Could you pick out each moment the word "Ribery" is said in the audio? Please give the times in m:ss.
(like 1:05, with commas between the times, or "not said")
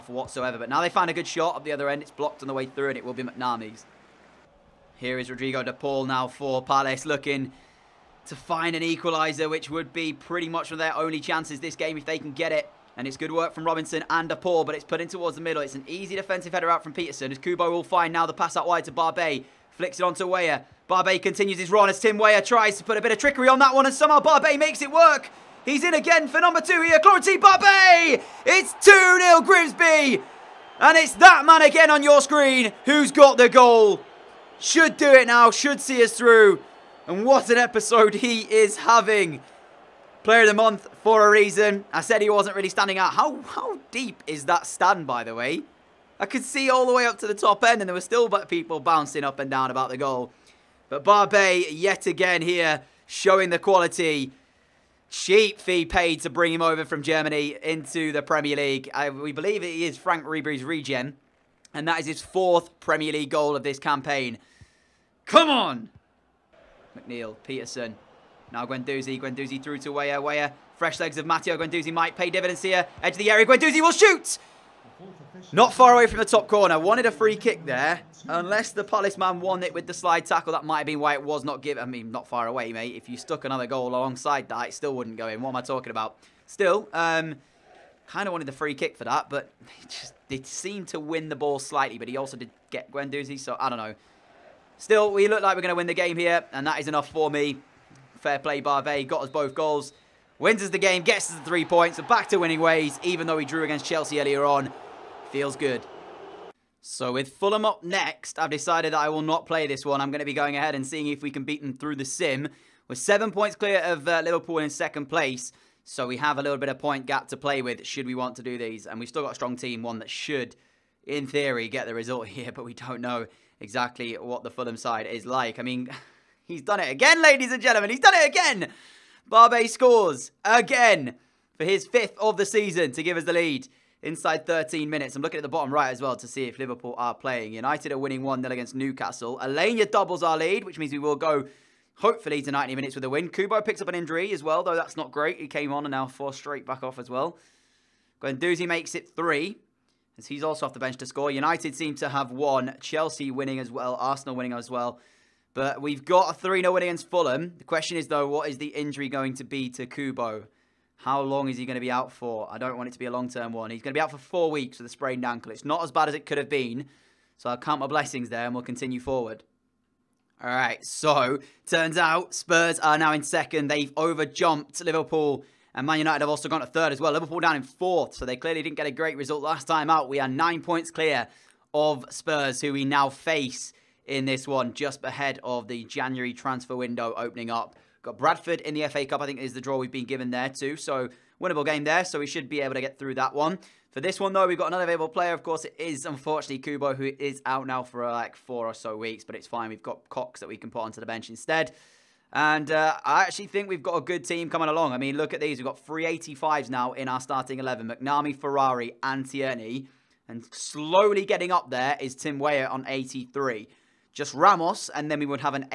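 1:00.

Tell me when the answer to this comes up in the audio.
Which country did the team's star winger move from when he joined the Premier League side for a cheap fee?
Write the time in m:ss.
0:57.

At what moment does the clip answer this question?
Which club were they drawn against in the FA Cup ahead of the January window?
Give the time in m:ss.
3:08.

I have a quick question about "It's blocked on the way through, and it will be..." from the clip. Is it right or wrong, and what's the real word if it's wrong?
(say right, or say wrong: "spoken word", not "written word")
right.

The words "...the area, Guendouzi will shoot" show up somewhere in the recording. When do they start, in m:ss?
1:13.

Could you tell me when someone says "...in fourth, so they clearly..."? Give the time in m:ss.
2:57.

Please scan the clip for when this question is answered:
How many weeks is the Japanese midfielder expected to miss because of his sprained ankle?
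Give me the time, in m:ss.
2:44.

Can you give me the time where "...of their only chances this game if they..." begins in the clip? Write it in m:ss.
0:10.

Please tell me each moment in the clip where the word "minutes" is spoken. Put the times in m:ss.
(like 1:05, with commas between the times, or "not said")
2:14, 2:22.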